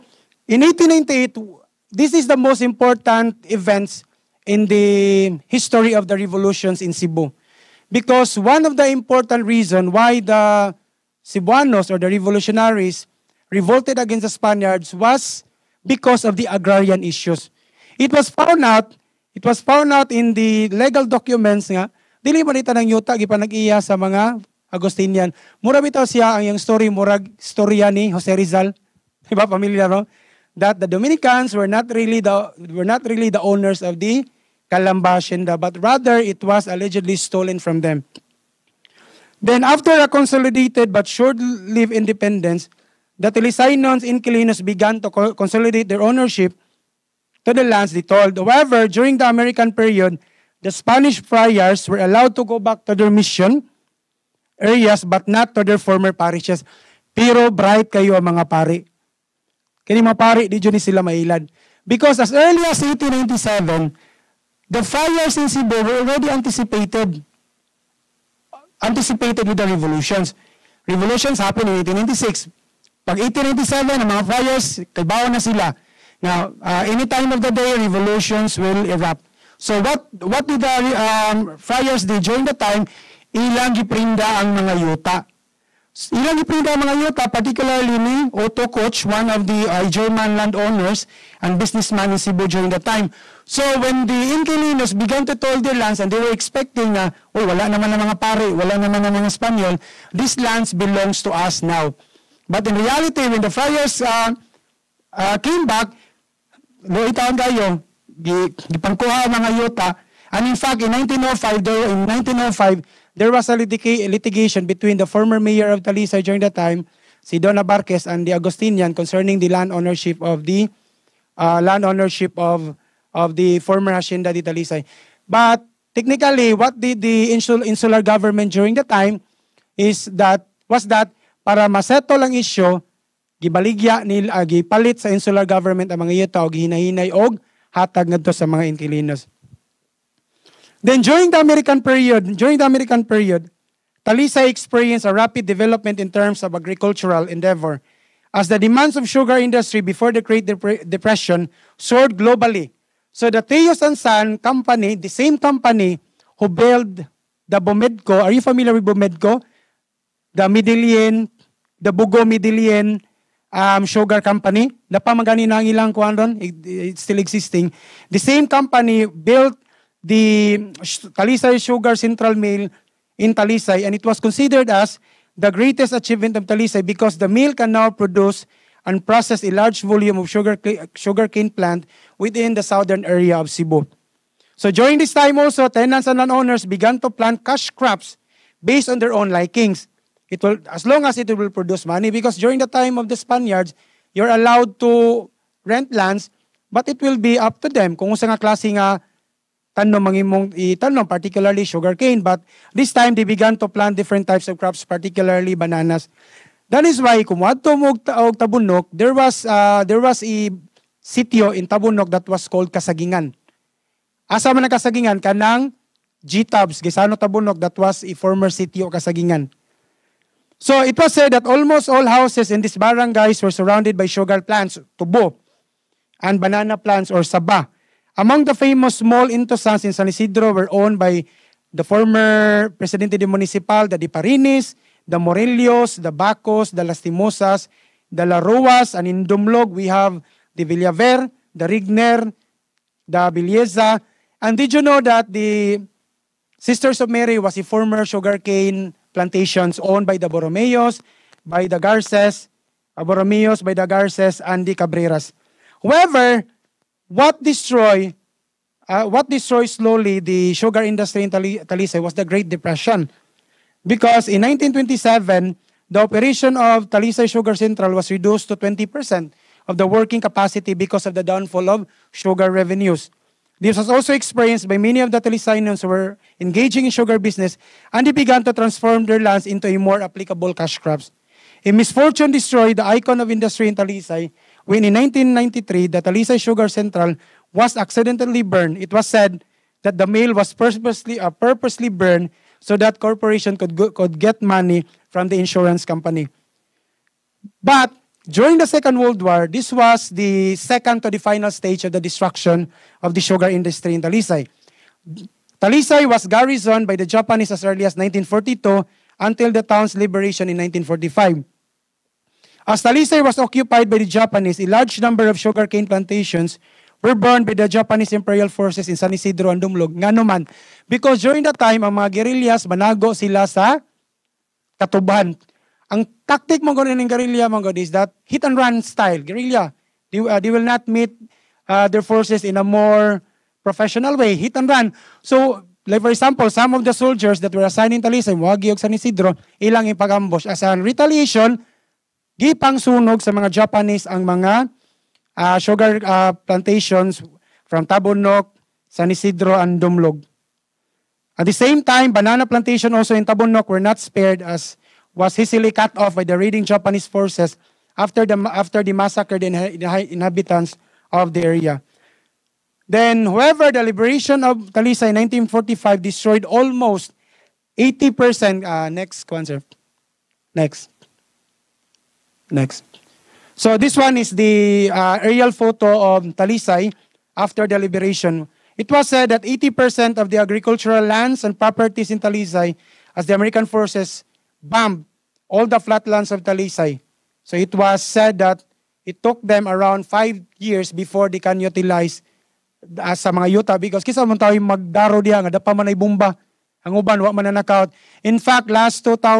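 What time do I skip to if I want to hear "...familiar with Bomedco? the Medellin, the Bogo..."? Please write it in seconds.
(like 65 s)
158 s.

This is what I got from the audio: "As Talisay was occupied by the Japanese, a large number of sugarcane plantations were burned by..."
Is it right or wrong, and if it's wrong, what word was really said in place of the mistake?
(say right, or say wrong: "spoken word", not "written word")
right.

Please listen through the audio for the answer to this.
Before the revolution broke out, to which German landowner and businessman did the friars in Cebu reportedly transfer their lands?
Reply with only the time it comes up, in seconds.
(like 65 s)
88 s.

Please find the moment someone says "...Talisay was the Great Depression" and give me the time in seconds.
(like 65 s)
261 s.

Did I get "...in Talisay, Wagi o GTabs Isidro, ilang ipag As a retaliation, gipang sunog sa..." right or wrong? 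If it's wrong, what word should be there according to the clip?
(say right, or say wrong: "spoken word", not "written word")
wrong: "San", not "GTabs".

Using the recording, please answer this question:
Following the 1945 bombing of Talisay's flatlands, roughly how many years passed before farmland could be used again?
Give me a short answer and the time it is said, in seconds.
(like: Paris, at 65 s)
5 years, at 390 s.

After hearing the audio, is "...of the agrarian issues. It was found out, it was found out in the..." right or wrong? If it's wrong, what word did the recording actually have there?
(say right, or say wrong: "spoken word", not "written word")
right.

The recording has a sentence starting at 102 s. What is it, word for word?
But in reality, when the friars uh, uh, came back, looy taon kayo, gipangkuha ang mga yuta.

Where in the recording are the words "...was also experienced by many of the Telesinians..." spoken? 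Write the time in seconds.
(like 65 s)
273 s.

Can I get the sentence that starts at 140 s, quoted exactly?
Then during the American period, during the American period, Talisay experienced a rapid development in terms of agricultural endeavor.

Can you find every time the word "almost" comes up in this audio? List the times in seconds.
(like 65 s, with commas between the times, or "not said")
221 s, 366 s.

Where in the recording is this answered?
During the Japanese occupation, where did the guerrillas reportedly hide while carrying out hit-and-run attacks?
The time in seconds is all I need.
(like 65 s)
324 s.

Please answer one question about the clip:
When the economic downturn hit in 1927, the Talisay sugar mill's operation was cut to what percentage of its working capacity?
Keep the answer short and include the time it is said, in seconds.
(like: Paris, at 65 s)
20%, at 268 s.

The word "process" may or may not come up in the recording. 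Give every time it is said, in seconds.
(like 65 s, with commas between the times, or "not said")
179 s.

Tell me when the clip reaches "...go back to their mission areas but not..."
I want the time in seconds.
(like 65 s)
52 s.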